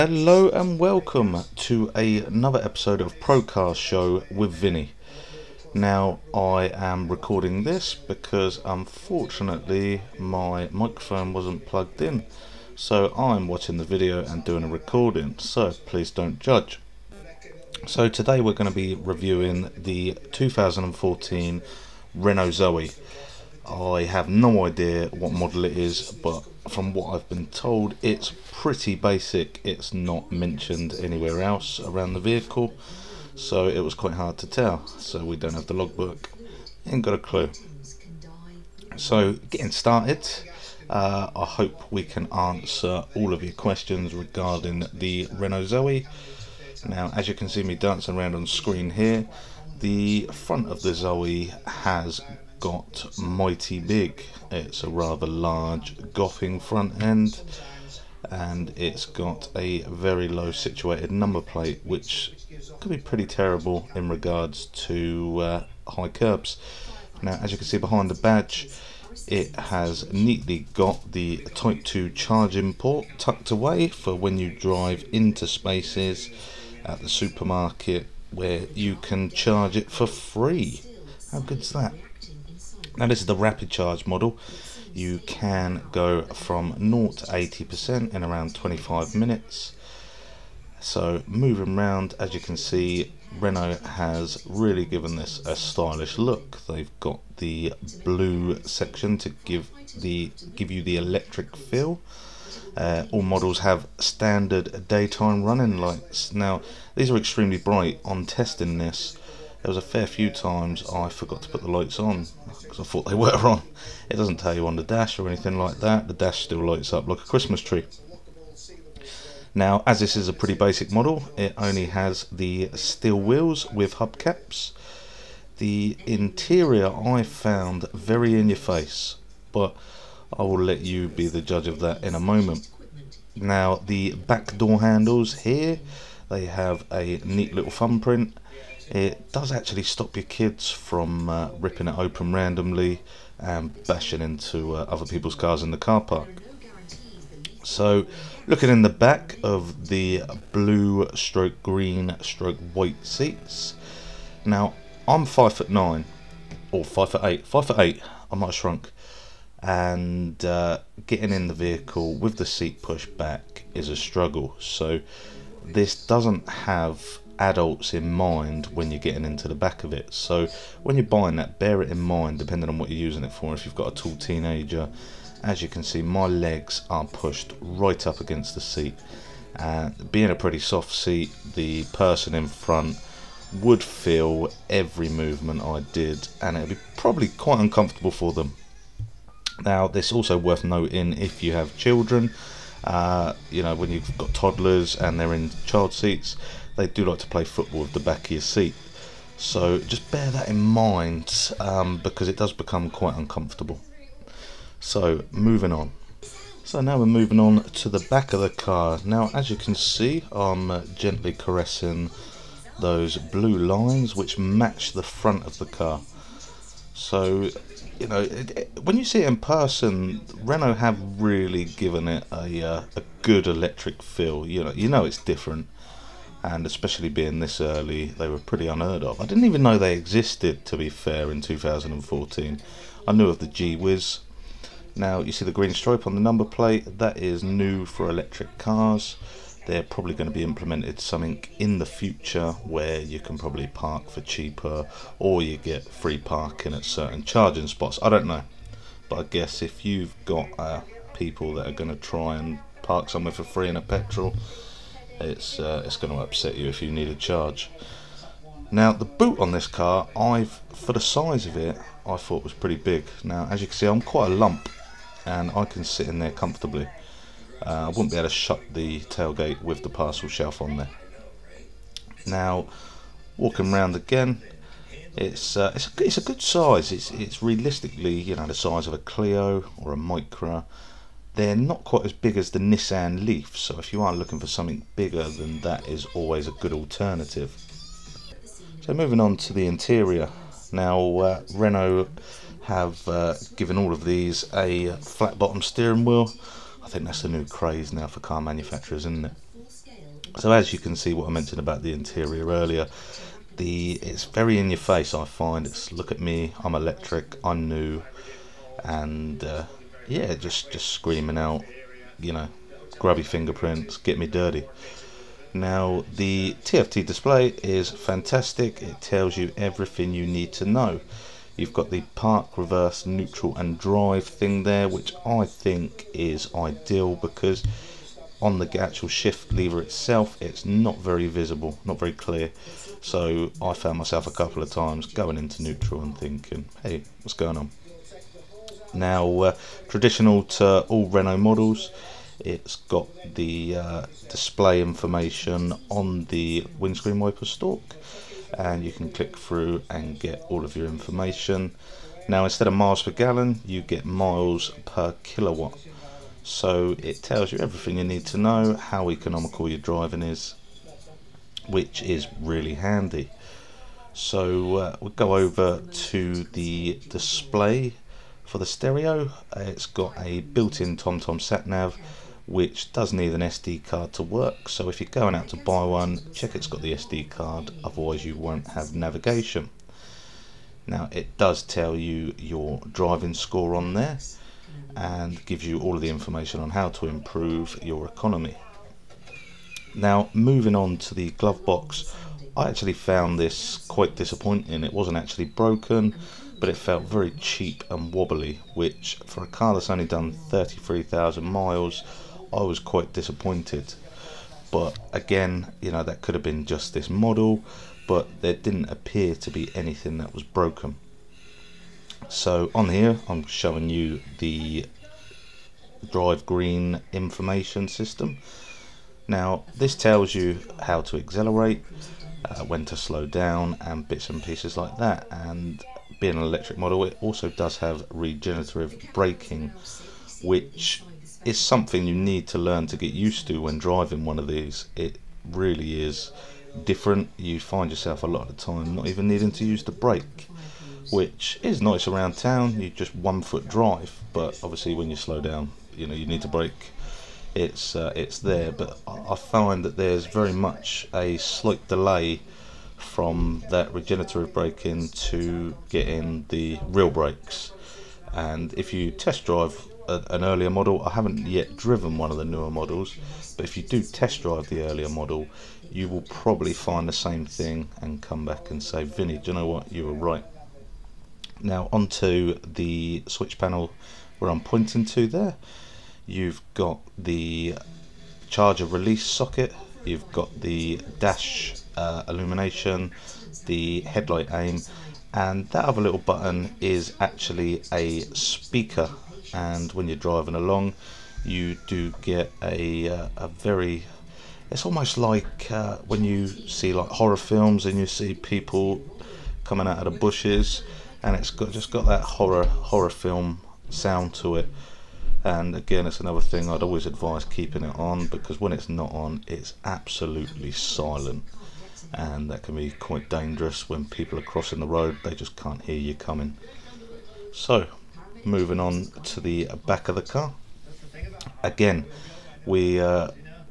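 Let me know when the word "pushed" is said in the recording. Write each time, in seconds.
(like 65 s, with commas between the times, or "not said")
162 s, 177 s.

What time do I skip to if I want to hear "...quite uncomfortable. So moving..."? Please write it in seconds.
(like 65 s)
202 s.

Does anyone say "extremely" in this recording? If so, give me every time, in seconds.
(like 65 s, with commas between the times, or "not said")
107 s.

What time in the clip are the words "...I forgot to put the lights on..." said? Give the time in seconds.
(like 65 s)
110 s.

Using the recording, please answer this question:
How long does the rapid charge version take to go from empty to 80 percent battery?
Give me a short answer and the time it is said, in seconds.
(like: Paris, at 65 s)
25 minutes, at 88 s.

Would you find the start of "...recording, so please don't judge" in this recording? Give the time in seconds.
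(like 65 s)
14 s.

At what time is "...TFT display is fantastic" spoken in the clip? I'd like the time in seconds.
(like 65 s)
316 s.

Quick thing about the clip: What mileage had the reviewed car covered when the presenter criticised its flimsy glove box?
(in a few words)
33,000 miles.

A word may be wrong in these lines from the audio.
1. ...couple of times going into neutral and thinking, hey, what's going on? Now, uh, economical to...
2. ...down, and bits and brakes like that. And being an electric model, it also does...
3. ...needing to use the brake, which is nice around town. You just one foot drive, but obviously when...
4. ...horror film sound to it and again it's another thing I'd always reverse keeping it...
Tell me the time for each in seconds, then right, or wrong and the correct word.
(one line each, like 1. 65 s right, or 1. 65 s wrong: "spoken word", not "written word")
1. 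334 s wrong: "traditional", not "economical"
2. 423 s wrong: "pieces", not "brakes"
3. 439 s right
4. 502 s wrong: "advise", not "reverse".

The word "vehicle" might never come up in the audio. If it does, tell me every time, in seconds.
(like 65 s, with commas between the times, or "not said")
32 s, 161 s.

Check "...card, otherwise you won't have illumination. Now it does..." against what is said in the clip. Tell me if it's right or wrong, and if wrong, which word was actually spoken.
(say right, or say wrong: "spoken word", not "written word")
wrong: "navigation", not "illumination".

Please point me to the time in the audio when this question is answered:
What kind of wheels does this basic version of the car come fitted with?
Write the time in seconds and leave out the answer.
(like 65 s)
122 s.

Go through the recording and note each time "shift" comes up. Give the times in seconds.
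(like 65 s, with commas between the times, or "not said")
329 s.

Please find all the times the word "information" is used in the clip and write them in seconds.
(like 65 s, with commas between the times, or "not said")
344 s, 350 s, 386 s, 417 s.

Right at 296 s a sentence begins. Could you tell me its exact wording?
I think that's the new craze now for car manufacturers, isn't it?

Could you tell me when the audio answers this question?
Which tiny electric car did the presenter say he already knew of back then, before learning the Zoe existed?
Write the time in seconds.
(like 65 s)
233 s.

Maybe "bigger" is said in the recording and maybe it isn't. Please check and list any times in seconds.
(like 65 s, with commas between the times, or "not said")
284 s.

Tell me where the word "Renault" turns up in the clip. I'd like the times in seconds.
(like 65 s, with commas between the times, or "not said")
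22 s, 45 s, 93 s, 220 s, 291 s, 341 s.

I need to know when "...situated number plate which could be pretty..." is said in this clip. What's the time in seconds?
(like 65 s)
60 s.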